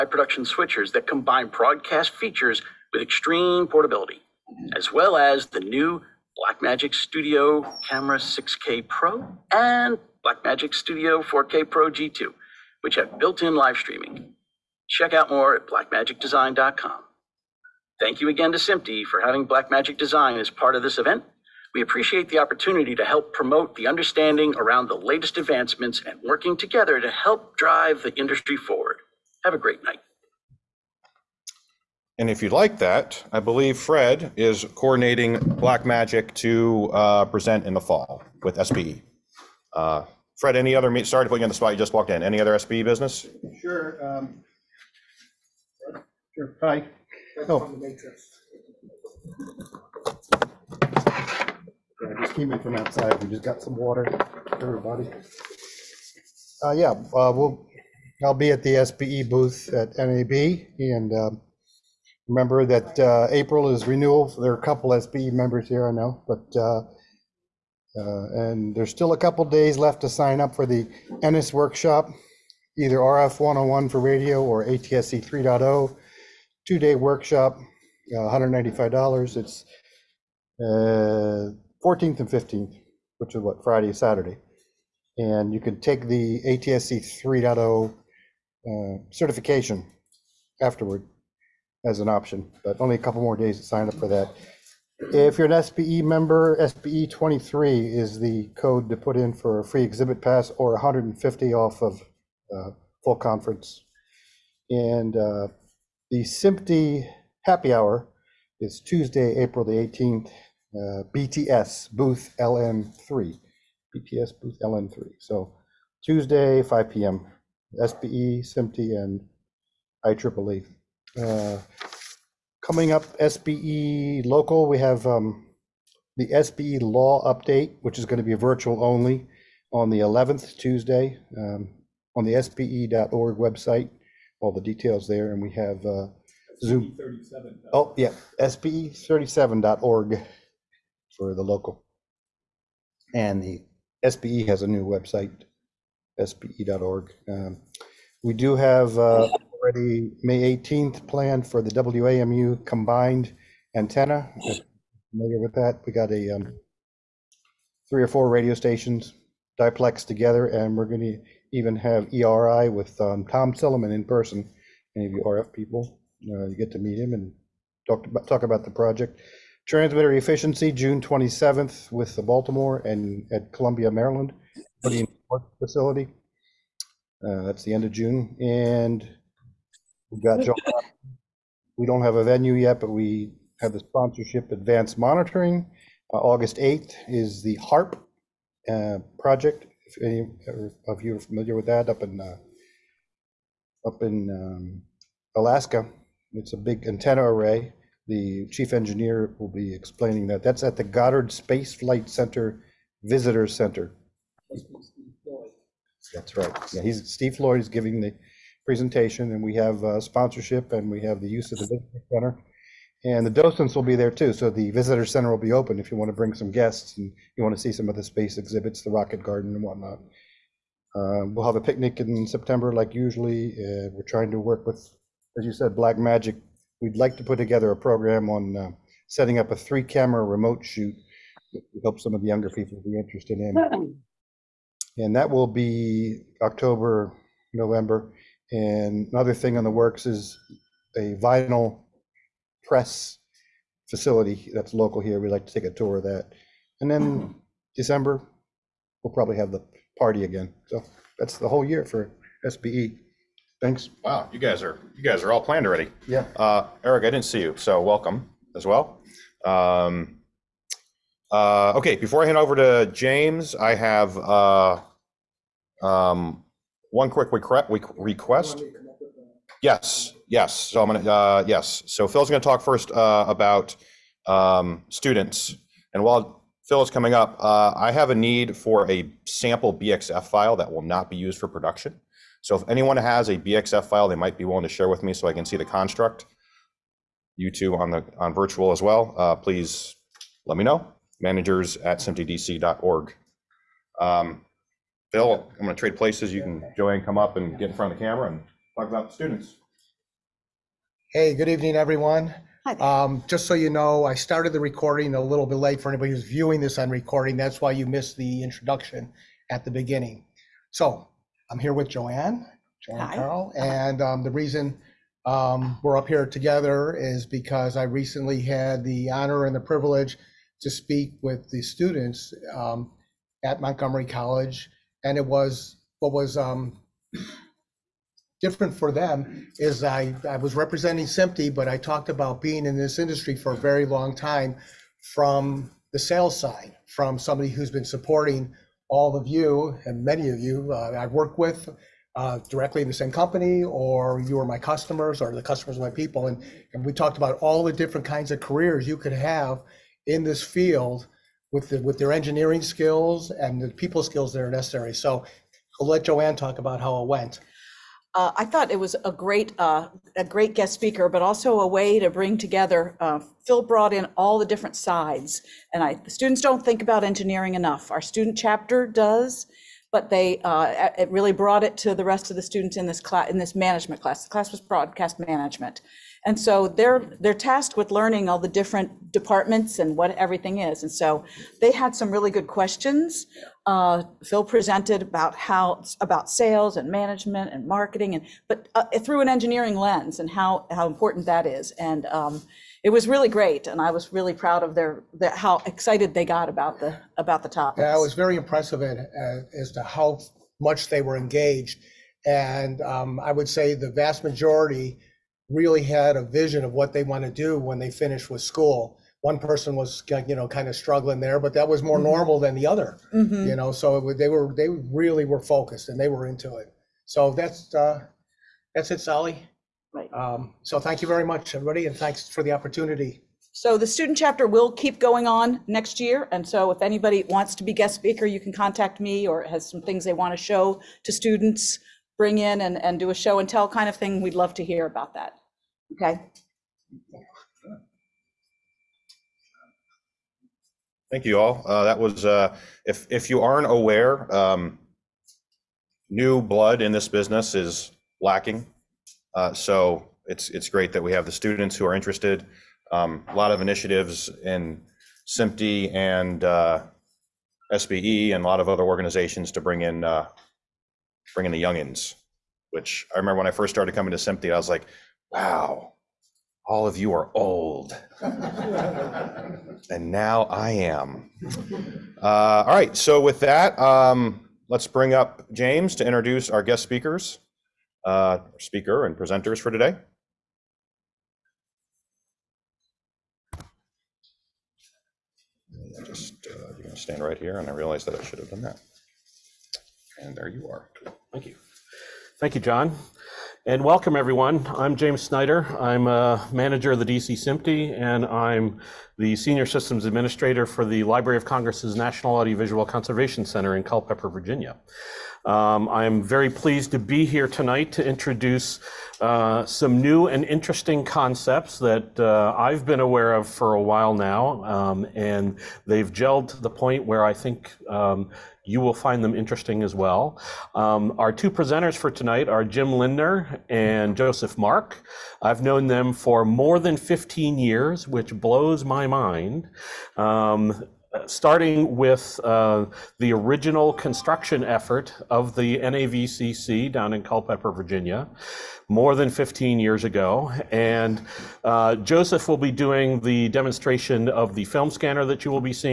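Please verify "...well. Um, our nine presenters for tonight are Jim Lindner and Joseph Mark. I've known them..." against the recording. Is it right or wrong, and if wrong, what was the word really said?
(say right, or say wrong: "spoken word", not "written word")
wrong: "two", not "nine".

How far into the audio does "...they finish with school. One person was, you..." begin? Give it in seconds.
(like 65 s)
407 s.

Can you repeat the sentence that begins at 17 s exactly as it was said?
Thank you again to SMPTE for having Blackmagic Design as part of this event.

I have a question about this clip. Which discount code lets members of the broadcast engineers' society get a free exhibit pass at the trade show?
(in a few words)
SBE 23.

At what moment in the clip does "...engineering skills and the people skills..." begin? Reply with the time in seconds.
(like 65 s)
352 s.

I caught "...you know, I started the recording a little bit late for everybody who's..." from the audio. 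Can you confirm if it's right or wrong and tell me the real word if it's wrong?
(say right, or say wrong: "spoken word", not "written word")
wrong: "anybody", not "everybody".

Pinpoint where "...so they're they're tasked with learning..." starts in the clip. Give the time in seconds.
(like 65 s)
376 s.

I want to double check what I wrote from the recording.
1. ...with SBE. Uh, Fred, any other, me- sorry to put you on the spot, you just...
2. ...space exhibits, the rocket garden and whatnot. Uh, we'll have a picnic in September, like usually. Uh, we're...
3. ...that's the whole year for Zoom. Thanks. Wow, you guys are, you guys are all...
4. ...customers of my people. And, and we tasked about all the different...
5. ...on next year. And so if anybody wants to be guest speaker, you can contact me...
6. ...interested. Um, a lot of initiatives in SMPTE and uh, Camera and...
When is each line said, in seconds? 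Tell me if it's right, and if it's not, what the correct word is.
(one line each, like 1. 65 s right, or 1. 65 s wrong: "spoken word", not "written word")
1. 38 s right
2. 218 s right
3. 251 s wrong: "SBE", not "Zoom"
4. 345 s wrong: "talked", not "tasked"
5. 425 s right
6. 451 s wrong: "SBE", not "Camera".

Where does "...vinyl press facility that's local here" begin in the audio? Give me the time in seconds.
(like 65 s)
241 s.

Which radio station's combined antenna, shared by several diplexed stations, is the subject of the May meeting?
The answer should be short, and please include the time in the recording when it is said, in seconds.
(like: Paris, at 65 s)
WAMU, at 151 s.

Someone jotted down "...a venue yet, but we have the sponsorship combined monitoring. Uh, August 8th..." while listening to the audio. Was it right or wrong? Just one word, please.
wrong.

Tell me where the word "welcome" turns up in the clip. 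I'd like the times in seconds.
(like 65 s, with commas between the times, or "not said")
257 s, 493 s.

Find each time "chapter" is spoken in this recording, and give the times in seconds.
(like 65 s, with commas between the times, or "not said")
368 s, 424 s.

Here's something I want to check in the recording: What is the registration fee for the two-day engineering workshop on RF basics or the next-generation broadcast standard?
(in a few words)
$195.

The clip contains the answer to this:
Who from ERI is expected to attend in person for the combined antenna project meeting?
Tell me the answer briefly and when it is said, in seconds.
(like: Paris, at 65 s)
Tom Silliman, at 163 s.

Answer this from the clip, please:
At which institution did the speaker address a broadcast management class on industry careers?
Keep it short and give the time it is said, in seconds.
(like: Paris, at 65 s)
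Montgomery College, at 323 s.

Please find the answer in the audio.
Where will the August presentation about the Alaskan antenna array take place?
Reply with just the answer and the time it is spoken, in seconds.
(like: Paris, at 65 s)
Goddard Space Flight Center Visitor Center, at 200 s.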